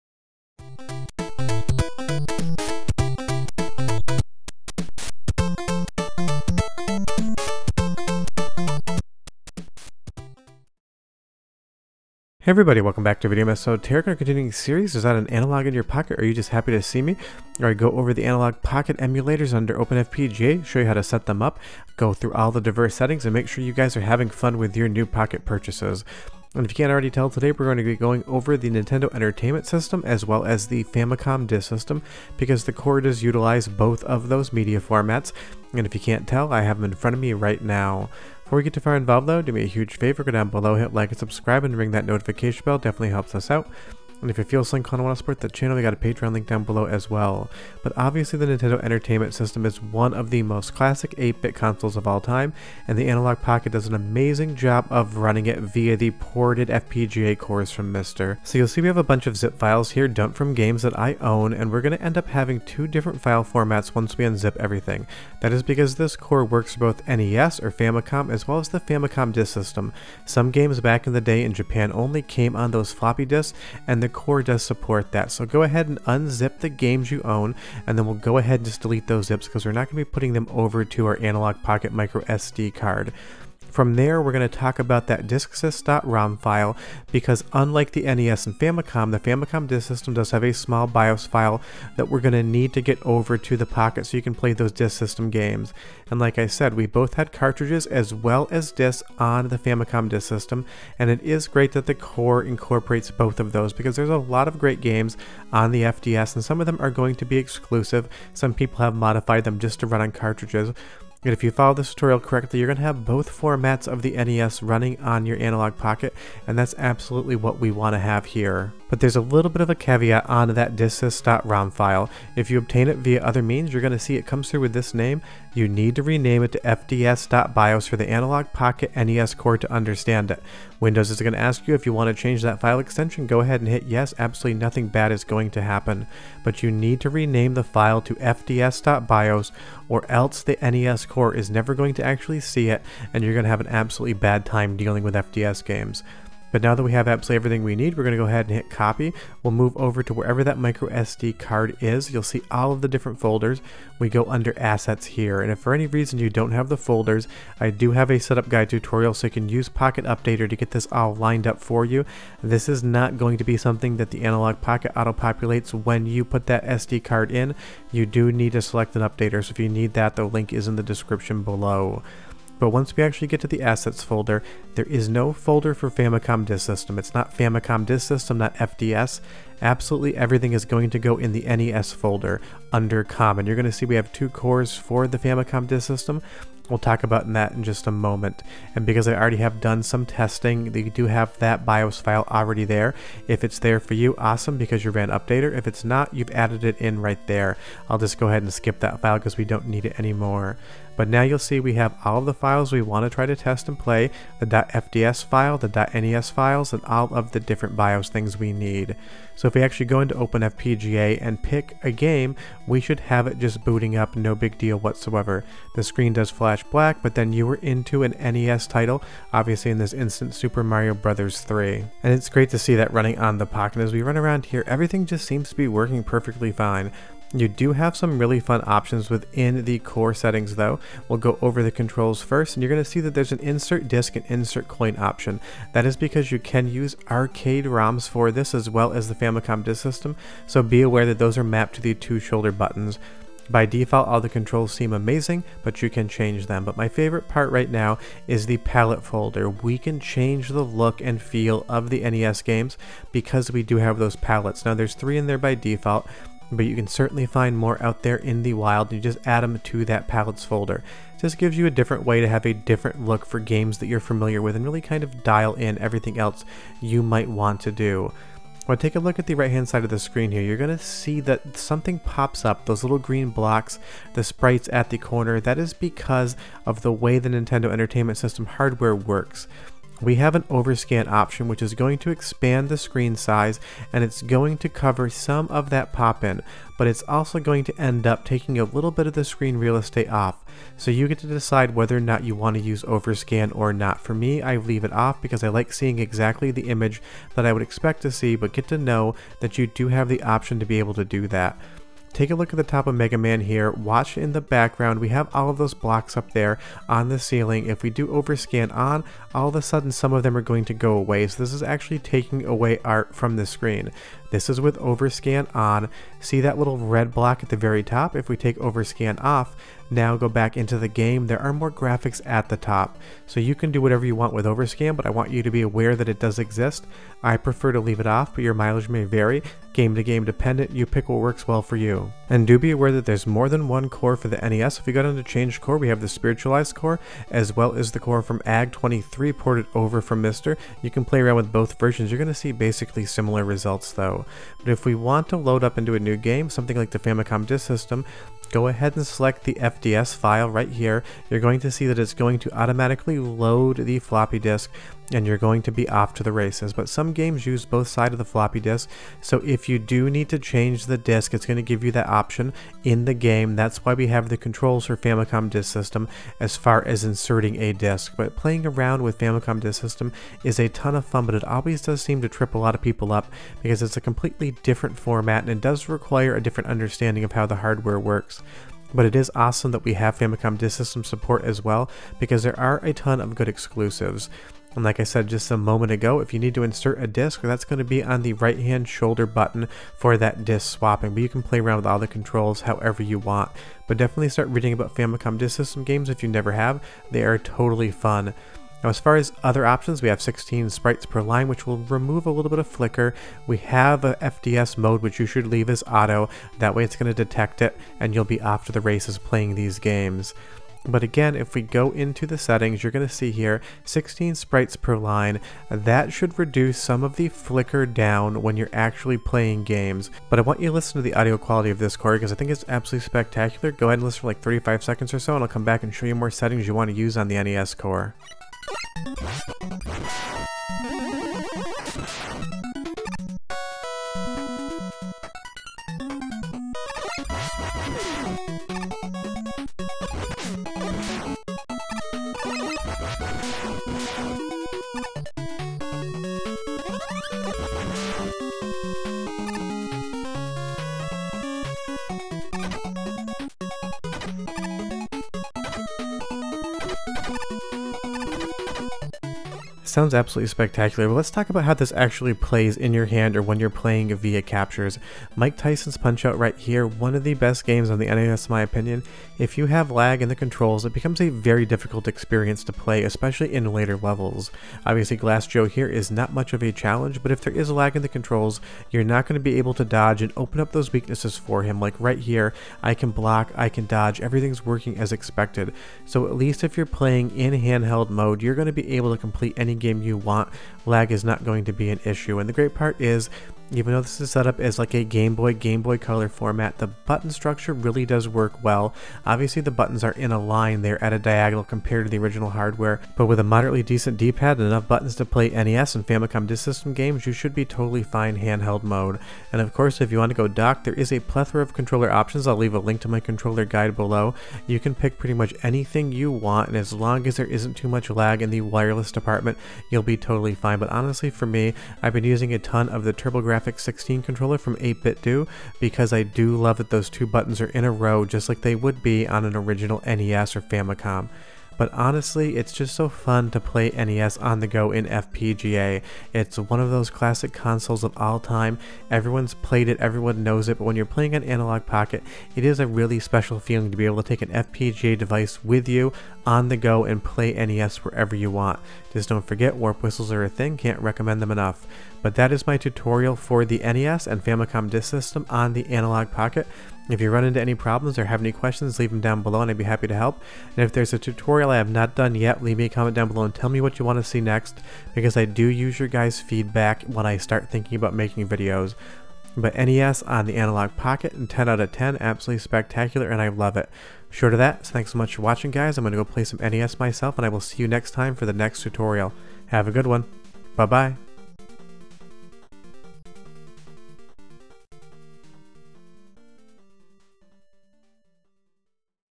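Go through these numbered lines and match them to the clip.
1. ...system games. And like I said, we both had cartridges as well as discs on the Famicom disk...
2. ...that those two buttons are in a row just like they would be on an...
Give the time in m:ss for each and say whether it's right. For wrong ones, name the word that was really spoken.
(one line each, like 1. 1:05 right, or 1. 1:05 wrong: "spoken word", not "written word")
1. 1:34 right
2. 8:46 right.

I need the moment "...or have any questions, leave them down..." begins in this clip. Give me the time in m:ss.
9:18.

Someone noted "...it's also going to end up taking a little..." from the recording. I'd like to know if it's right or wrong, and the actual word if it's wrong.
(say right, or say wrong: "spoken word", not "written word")
right.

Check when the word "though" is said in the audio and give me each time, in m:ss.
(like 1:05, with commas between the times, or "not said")
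0:39, 3:50, 5:43, 8:13.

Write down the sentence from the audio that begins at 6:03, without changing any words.
That's why we have the controls for Famicom Disk System as far as inserting a disk.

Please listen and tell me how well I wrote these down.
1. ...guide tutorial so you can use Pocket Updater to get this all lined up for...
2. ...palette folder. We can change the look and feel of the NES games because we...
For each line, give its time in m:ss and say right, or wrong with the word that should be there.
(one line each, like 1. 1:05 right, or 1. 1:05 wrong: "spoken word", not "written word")
1. 2:38 right
2. 4:08 right.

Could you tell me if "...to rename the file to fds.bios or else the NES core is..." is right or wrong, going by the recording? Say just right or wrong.
right.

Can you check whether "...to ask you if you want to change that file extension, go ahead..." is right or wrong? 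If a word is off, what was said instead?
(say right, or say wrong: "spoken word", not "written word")
right.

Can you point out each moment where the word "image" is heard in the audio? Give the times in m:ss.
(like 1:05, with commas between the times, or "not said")
4:56.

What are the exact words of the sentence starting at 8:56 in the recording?
It's one of those classic consoles of all time.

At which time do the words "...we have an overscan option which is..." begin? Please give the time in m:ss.
4:40.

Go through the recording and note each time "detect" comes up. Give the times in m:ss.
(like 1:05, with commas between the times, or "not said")
6:47.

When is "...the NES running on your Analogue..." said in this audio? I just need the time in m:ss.
1:54.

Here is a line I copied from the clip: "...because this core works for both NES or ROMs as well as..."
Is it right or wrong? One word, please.
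wrong.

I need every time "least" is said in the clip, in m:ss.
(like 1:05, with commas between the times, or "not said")
8:06.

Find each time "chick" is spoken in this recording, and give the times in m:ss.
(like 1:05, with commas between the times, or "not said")
not said.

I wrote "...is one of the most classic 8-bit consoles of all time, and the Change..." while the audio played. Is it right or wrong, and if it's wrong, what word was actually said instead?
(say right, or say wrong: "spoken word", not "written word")
wrong: "Analogue", not "Change".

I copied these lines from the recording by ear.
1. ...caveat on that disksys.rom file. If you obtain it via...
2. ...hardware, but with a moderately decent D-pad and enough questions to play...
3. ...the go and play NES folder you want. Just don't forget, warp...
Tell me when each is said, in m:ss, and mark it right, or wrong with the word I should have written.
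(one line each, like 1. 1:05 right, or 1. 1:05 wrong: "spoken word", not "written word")
1. 1:59 right
2. 8:22 wrong: "buttons", not "questions"
3. 9:06 wrong: "wherever", not "folder".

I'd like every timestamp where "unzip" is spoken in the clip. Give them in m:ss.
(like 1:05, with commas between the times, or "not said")
1:04, 1:16.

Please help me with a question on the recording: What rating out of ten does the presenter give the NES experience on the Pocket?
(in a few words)
10.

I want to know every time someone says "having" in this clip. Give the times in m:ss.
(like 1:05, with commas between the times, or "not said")
0:24, 1:02.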